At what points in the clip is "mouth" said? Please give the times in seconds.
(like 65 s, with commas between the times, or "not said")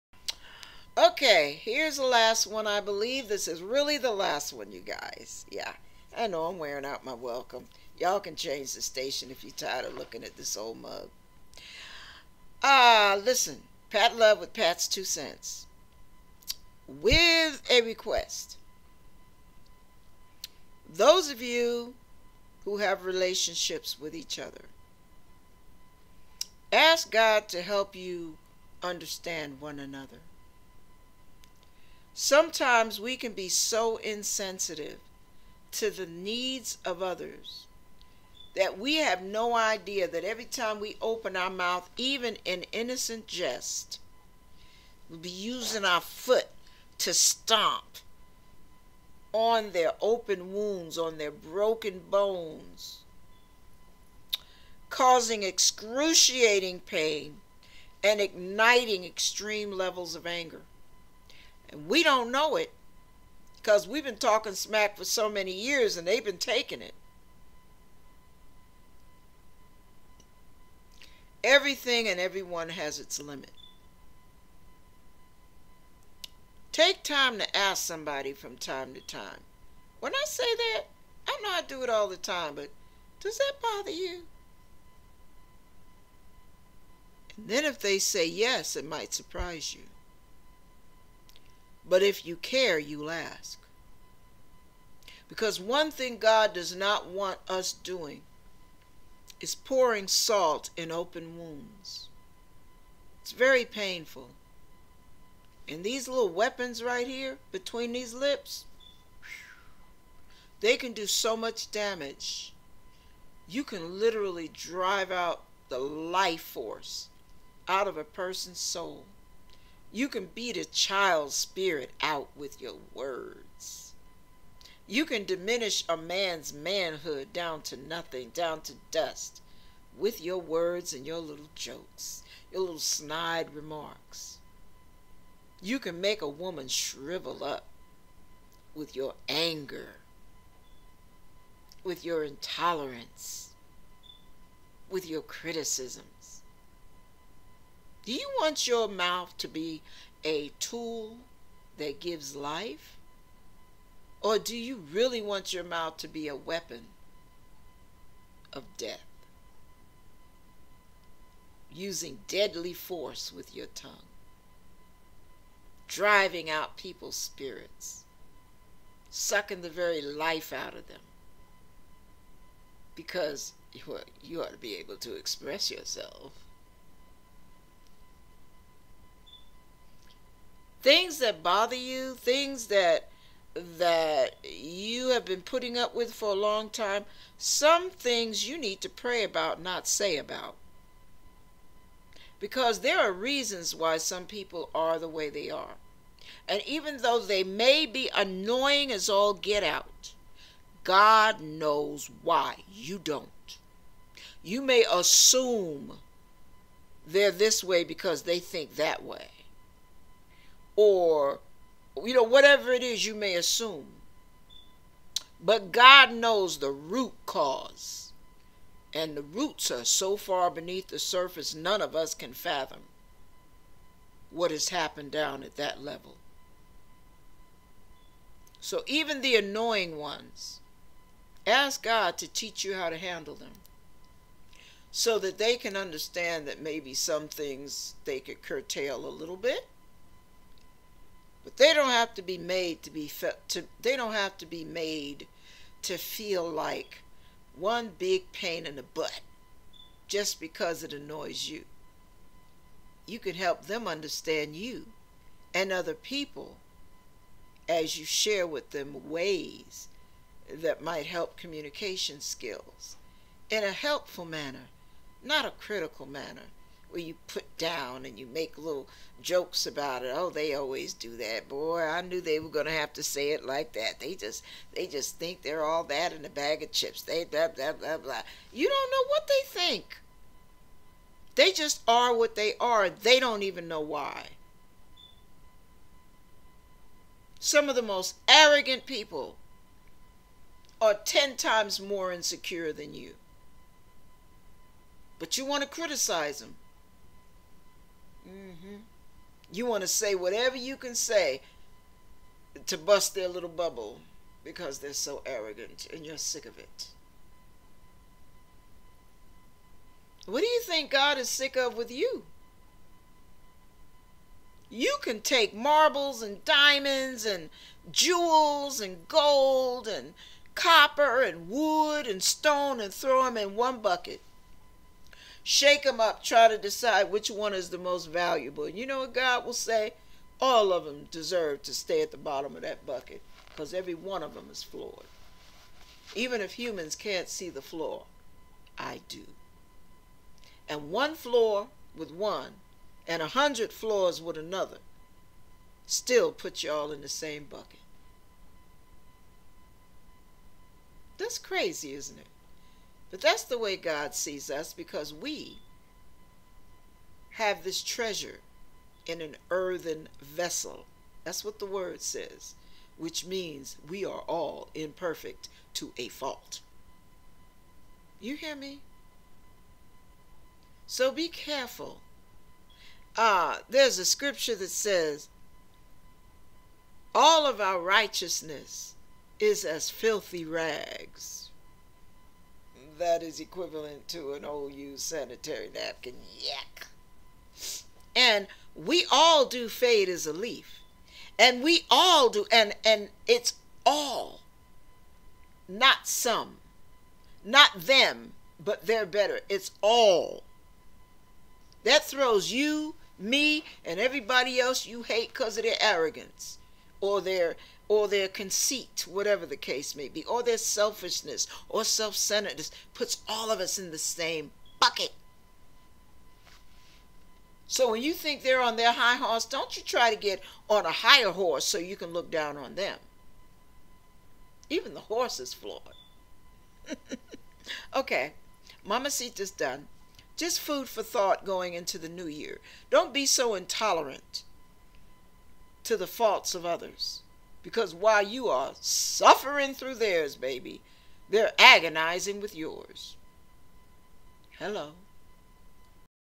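41 s, 148 s, 155 s.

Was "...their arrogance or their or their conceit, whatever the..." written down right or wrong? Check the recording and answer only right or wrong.
right.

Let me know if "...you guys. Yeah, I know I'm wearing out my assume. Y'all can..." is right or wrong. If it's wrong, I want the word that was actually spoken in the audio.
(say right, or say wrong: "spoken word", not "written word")
wrong: "welcome", not "assume".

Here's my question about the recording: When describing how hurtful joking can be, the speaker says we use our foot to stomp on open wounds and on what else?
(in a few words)
broken bones.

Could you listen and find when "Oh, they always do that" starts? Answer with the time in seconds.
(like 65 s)
270 s.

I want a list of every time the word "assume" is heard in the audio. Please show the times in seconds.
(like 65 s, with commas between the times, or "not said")
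204 s, 213 s.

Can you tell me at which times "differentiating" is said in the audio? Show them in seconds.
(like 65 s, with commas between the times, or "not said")
not said.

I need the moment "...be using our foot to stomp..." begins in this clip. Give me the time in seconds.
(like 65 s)
45 s.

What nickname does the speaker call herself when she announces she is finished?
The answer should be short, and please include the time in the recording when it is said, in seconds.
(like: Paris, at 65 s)
Mamacita, at 428 s.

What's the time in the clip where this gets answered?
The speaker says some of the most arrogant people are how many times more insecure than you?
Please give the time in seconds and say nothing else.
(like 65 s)
290 s.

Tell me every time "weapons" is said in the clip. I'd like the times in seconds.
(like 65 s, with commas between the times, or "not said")
106 s, 156 s.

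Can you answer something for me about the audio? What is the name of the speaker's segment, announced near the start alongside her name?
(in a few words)
Pat's Two Cents.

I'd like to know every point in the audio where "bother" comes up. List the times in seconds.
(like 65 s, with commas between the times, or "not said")
83 s, 181 s.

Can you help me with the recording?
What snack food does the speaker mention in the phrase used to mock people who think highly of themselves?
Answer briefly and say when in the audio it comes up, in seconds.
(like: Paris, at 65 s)
chips, at 276 s.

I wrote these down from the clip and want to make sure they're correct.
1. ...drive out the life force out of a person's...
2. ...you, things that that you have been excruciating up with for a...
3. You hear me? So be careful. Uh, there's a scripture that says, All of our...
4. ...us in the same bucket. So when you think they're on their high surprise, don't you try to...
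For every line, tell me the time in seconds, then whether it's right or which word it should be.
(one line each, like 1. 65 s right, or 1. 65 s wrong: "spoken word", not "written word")
1. 114 s right
2. 181 s wrong: "putting", not "excruciating"
3. 368 s right
4. 413 s wrong: "horse", not "surprise".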